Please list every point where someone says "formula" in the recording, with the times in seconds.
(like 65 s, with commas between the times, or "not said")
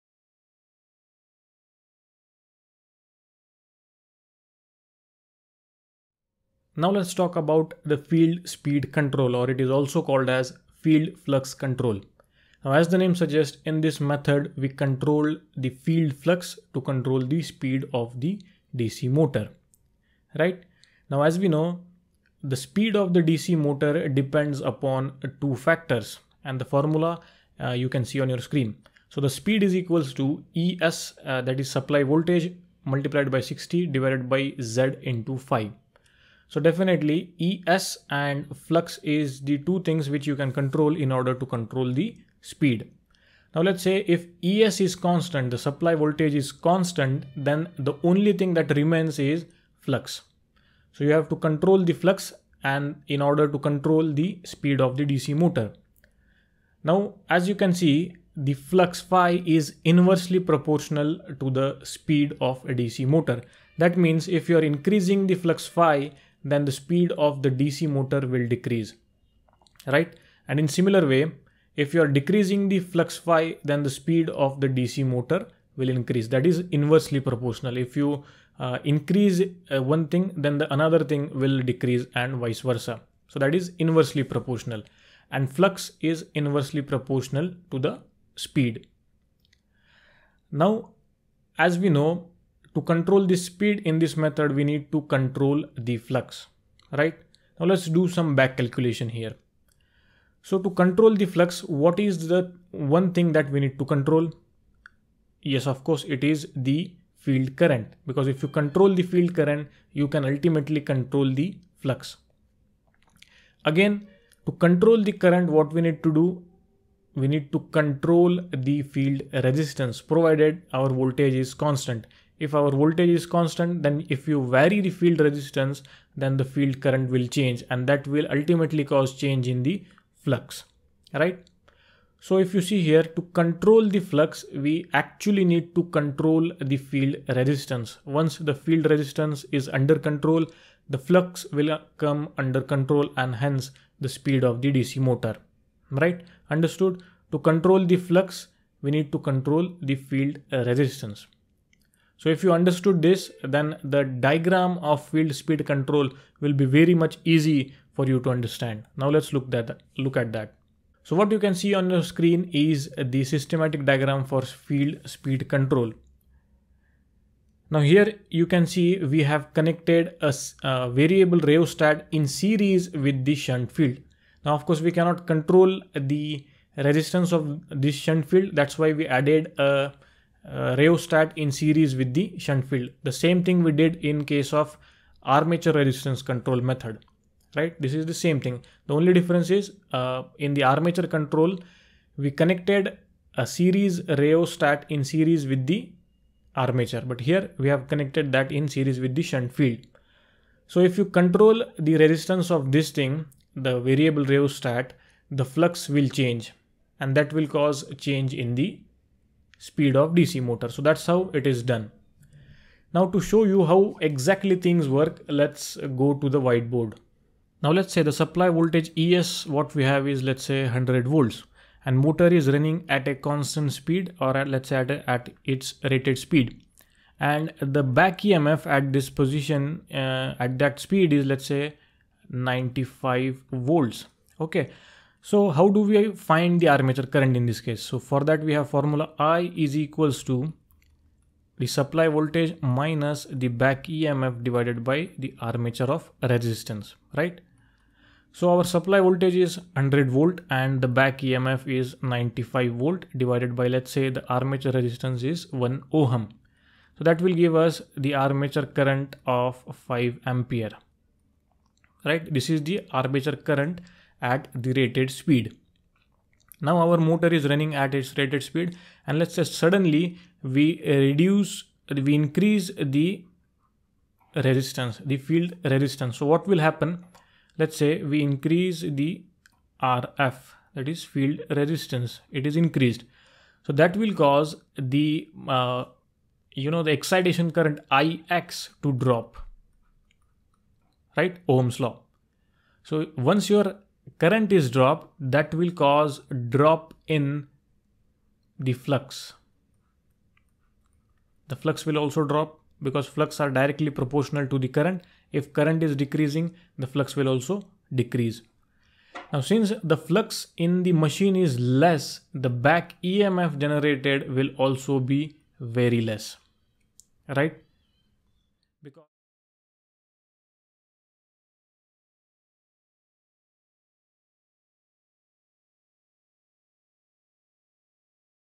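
26 s, 238 s.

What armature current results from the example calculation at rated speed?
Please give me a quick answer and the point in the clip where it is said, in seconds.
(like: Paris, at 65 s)
5 amperes, at 259 s.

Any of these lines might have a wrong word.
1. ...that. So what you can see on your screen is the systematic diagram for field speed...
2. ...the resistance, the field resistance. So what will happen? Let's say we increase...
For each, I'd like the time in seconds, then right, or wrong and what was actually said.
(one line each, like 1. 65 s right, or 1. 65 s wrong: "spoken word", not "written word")
1. 160 s right
2. 272 s right.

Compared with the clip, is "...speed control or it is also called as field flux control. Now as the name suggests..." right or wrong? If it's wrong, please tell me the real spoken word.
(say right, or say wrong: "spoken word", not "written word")
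right.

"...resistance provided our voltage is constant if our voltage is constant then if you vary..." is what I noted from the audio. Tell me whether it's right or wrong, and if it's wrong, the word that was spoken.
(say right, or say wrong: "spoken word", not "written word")
right.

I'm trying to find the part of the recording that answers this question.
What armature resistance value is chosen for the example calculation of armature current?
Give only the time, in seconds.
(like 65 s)
255 s.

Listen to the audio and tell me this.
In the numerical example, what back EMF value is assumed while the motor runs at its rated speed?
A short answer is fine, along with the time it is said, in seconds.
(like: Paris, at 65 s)
95 volts, at 232 s.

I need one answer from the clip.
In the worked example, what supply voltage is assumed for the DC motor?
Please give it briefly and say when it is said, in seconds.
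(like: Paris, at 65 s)
100 volts, at 220 s.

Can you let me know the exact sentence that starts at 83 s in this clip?
So that is inversely proportional and flux is inversely proportional to the speed.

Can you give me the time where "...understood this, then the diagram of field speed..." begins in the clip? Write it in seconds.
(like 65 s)
152 s.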